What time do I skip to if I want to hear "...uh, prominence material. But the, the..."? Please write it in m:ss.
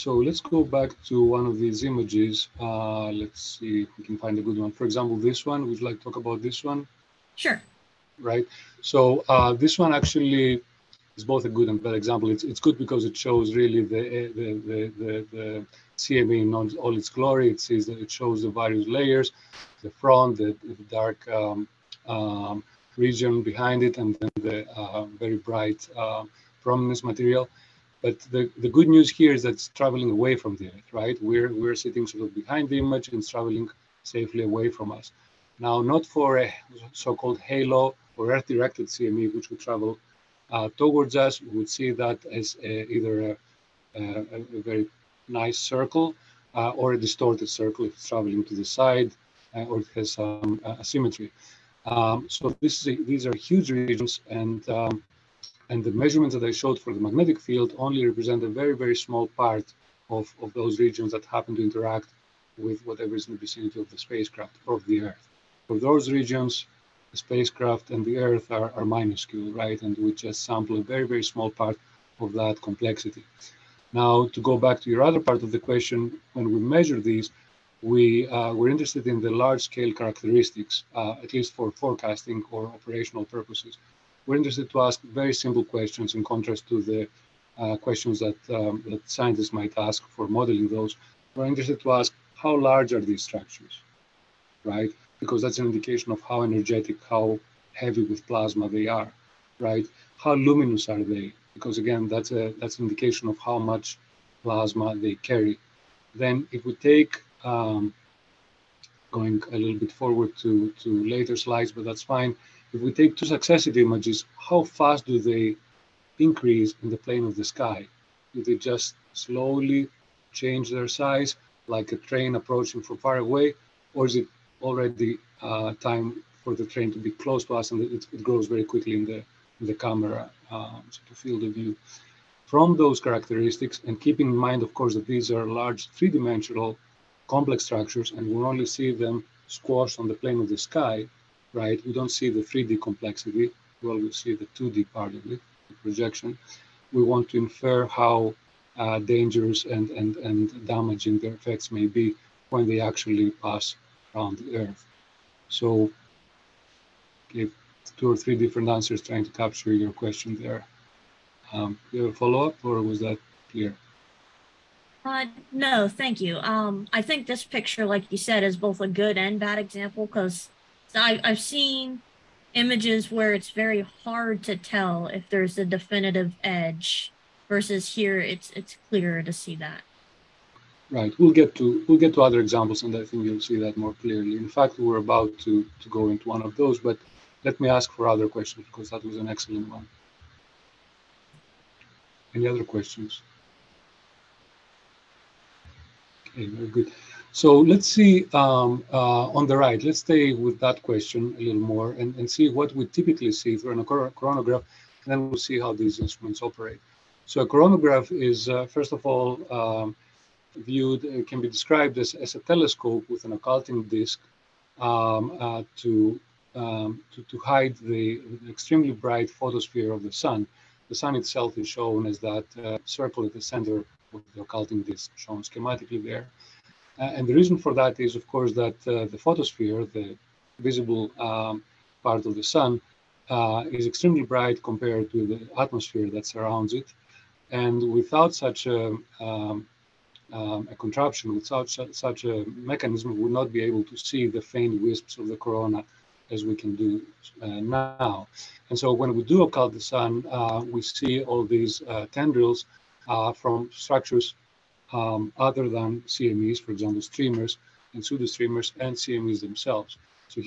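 0:25.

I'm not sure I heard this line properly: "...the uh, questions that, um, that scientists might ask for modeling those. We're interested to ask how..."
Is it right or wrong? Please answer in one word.
right.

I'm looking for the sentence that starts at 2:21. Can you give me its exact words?
We don't see the 3D complexity.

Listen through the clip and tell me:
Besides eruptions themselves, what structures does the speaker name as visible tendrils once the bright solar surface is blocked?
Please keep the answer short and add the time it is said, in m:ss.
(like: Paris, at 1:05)
streamers and pseudo streamers, at 4:17.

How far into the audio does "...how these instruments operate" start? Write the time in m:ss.
3:25.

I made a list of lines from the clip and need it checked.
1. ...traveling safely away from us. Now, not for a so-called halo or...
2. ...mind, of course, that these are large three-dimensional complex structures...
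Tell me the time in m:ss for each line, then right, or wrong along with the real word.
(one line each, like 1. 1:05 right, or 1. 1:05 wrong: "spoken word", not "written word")
1. 0:33 right
2. 2:14 right.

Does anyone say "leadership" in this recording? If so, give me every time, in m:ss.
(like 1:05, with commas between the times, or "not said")
not said.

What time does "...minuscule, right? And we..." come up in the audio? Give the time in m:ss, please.
1:08.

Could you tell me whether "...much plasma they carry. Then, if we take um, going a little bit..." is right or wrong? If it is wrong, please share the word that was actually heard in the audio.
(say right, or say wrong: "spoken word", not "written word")
right.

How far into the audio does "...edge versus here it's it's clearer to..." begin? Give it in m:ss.
2:56.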